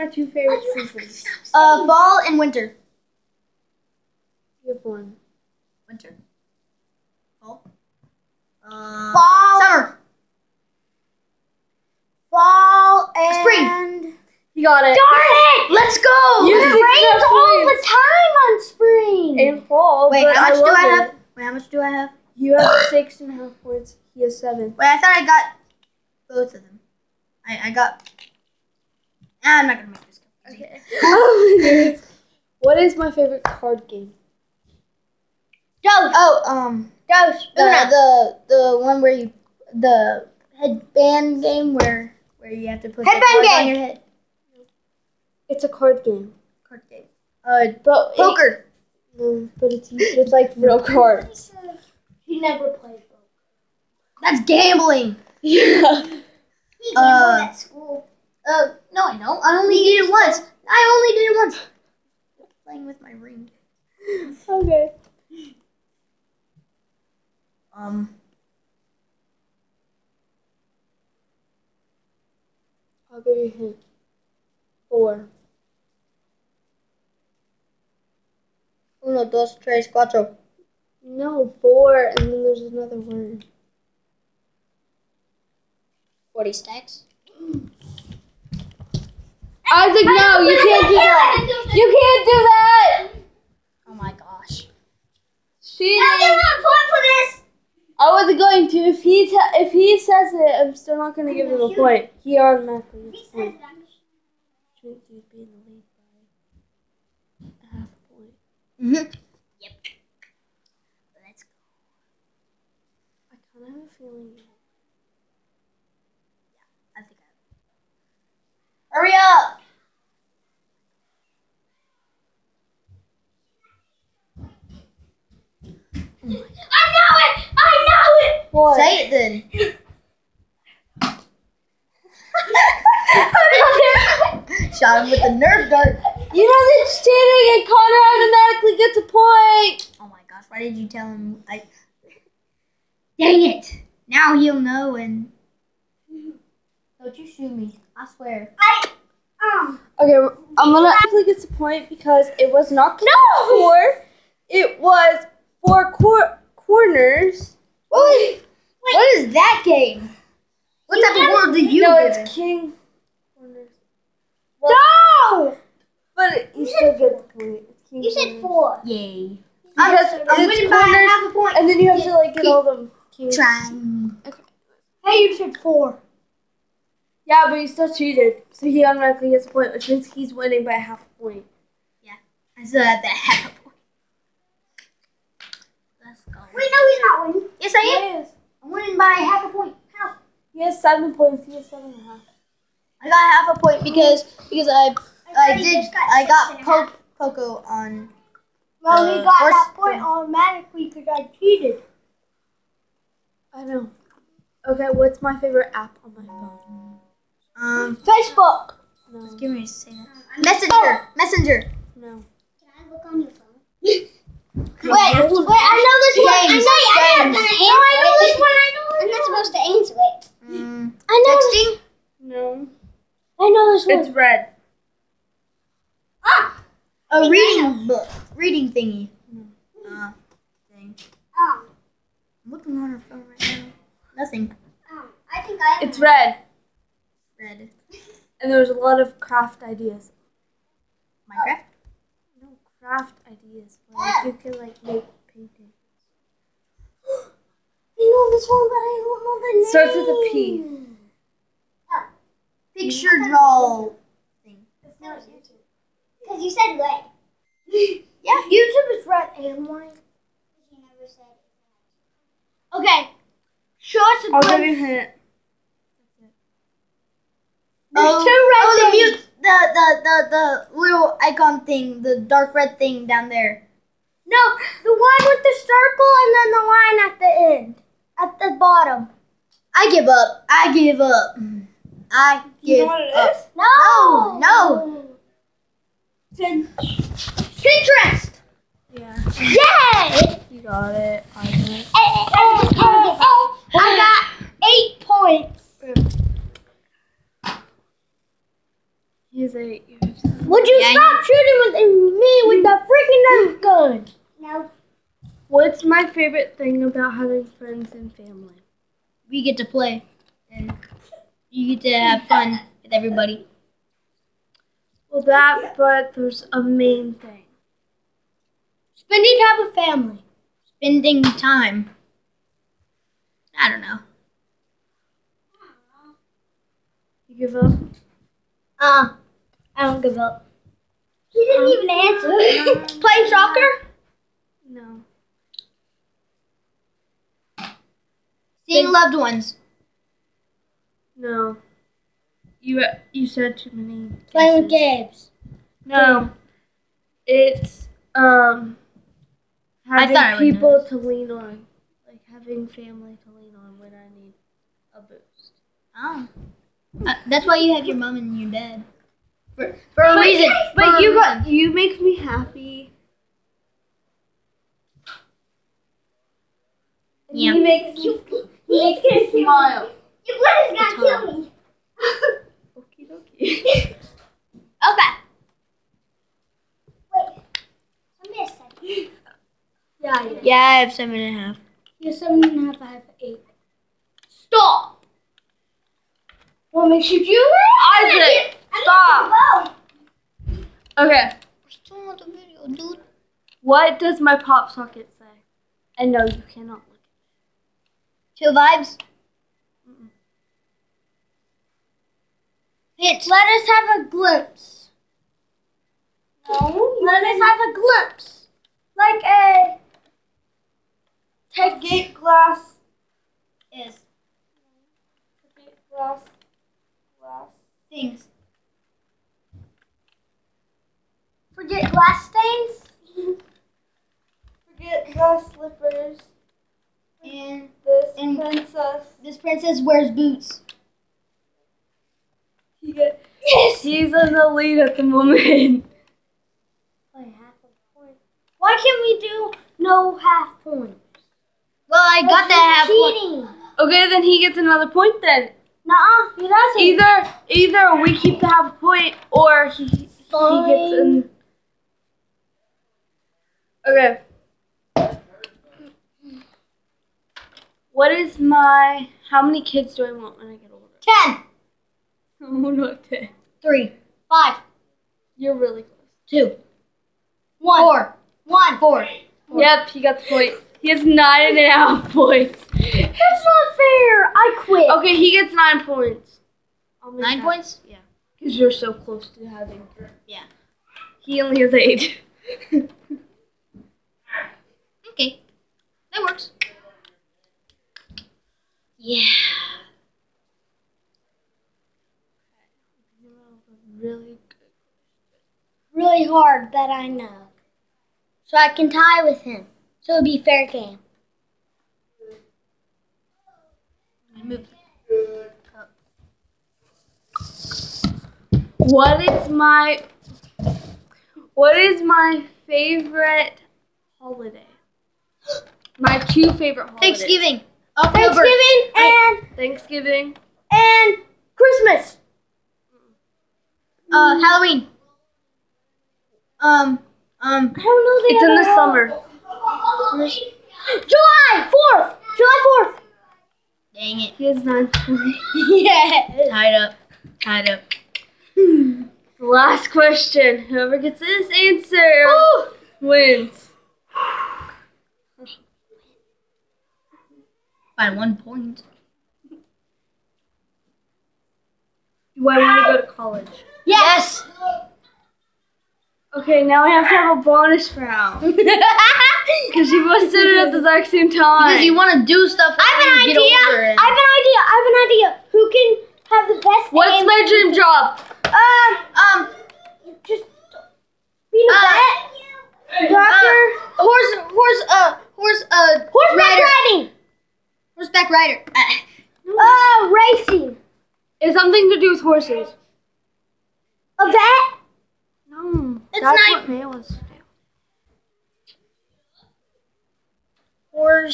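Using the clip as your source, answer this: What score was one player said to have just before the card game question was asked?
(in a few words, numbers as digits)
6.5 points.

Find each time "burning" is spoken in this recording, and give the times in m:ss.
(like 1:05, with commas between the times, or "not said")
not said.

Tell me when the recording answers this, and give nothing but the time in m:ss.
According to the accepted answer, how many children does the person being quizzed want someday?
7:49.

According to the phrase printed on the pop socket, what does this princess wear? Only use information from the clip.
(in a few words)
Boots.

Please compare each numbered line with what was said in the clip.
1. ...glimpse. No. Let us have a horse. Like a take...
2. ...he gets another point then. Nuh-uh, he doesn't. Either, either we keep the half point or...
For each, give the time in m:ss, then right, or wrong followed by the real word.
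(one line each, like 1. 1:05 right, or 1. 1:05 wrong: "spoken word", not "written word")
1. 6:44 wrong: "glimpse", not "horse"
2. 7:24 right.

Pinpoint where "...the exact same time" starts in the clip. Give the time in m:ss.
9:20.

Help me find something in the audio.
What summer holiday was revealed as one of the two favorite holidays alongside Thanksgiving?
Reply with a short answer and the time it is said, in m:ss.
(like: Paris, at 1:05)
July fourth, at 8:52.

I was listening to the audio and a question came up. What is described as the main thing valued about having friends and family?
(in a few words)
People to lean on.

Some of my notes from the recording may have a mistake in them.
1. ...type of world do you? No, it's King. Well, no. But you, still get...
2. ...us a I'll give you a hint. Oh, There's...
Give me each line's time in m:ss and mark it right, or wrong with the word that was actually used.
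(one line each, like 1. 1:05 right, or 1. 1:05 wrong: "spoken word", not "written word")
1. 2:41 right
2. 4:23 right.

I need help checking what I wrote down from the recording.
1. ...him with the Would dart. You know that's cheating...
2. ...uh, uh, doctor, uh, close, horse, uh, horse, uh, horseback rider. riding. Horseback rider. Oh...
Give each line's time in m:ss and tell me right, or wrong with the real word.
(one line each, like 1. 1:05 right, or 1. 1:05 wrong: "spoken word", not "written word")
1. 2:15 wrong: "Nerf", not "Would"
2. 9:32 wrong: "horse", not "close".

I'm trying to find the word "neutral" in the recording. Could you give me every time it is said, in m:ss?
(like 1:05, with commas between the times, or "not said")
not said.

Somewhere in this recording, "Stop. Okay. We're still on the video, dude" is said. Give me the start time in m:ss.
6:28.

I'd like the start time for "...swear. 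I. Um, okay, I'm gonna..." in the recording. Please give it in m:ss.
2:28.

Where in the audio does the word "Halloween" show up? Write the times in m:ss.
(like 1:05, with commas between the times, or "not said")
8:44.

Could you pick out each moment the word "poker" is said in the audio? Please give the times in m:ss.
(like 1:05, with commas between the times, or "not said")
0:48, 0:53.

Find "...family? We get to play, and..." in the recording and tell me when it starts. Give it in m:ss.
5:08.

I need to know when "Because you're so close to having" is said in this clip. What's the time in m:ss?
7:58.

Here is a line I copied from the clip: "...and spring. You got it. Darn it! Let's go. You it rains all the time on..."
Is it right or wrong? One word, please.
right.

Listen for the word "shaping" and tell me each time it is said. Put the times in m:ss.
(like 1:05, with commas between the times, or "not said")
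not said.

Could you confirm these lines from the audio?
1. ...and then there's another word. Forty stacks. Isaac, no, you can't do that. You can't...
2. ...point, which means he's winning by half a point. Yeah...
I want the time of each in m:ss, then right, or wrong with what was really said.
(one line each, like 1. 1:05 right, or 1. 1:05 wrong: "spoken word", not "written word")
1. 1:22 right
2. 2:59 right.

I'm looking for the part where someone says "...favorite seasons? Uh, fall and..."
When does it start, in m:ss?
0:00.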